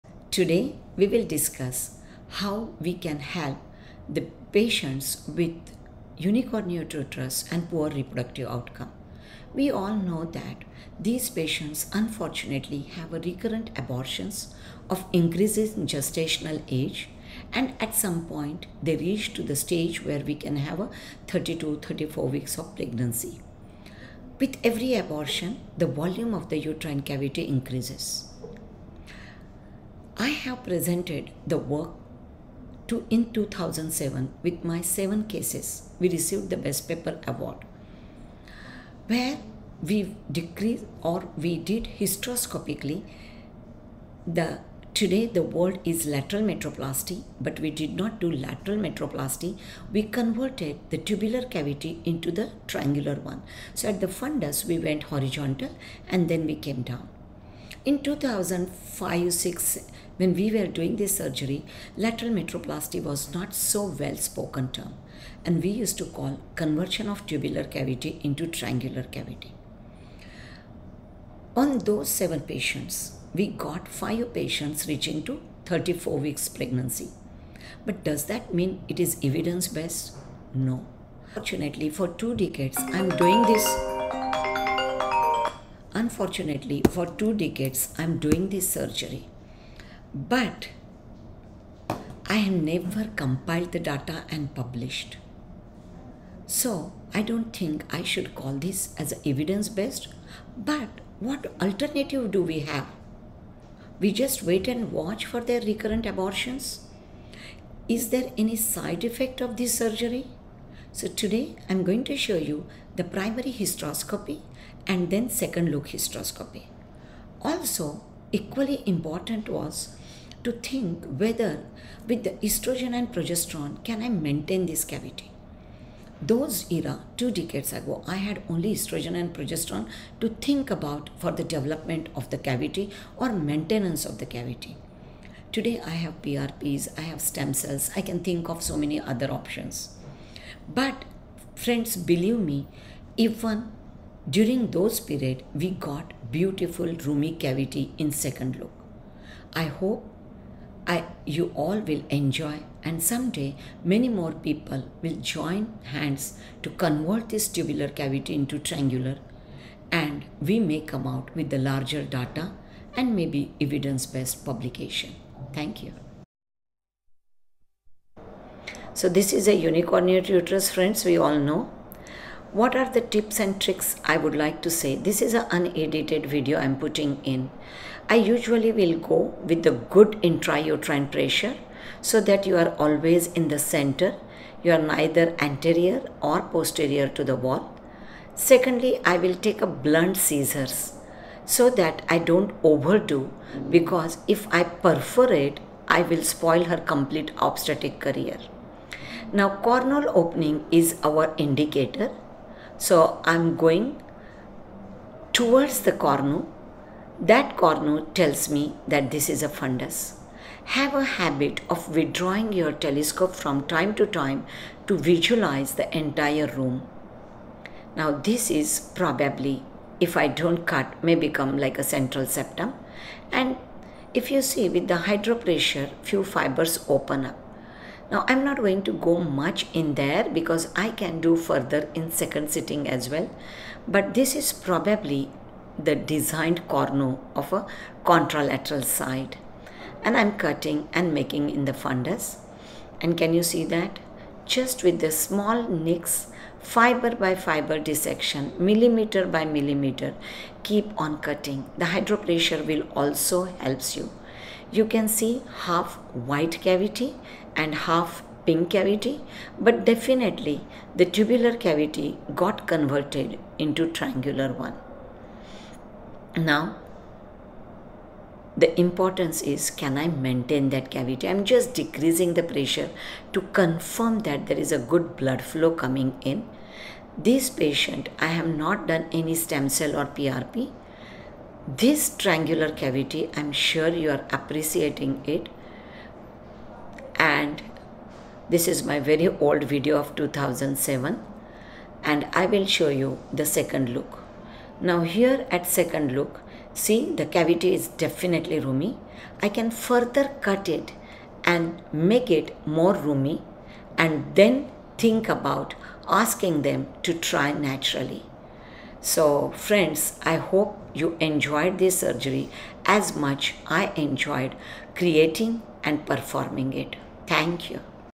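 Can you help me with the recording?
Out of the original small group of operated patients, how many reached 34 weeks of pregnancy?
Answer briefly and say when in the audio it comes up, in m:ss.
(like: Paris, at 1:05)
5, at 1:13.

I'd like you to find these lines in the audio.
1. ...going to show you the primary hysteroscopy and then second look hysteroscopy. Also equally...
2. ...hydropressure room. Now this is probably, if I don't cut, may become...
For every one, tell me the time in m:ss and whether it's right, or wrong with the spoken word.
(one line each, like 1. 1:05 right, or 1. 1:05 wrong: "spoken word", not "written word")
1. 1:51 right
2. 3:35 wrong: "entire", not "hydropressure".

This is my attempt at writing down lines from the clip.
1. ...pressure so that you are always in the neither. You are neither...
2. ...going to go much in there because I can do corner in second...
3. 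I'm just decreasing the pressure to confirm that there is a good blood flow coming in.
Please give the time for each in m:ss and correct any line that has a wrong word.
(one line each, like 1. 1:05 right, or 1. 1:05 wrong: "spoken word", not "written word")
1. 3:01 wrong: "center", not "neither"
2. 3:48 wrong: "further", not "corner"
3. 4:31 right.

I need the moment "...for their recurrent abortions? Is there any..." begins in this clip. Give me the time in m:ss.
1:45.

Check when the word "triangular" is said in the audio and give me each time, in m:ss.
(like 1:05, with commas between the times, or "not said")
0:52, 1:08, 2:38, 4:23, 4:42.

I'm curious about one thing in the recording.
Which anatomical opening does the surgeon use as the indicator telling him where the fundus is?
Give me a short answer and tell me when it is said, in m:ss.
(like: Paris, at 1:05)
Cornual opening, at 3:19.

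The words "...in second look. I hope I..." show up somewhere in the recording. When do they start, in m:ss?
2:27.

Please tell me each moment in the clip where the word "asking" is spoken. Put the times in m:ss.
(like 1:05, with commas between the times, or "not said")
5:06.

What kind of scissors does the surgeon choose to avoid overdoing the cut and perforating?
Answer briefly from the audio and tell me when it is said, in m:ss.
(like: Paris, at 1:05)
Blunt scissors, at 3:09.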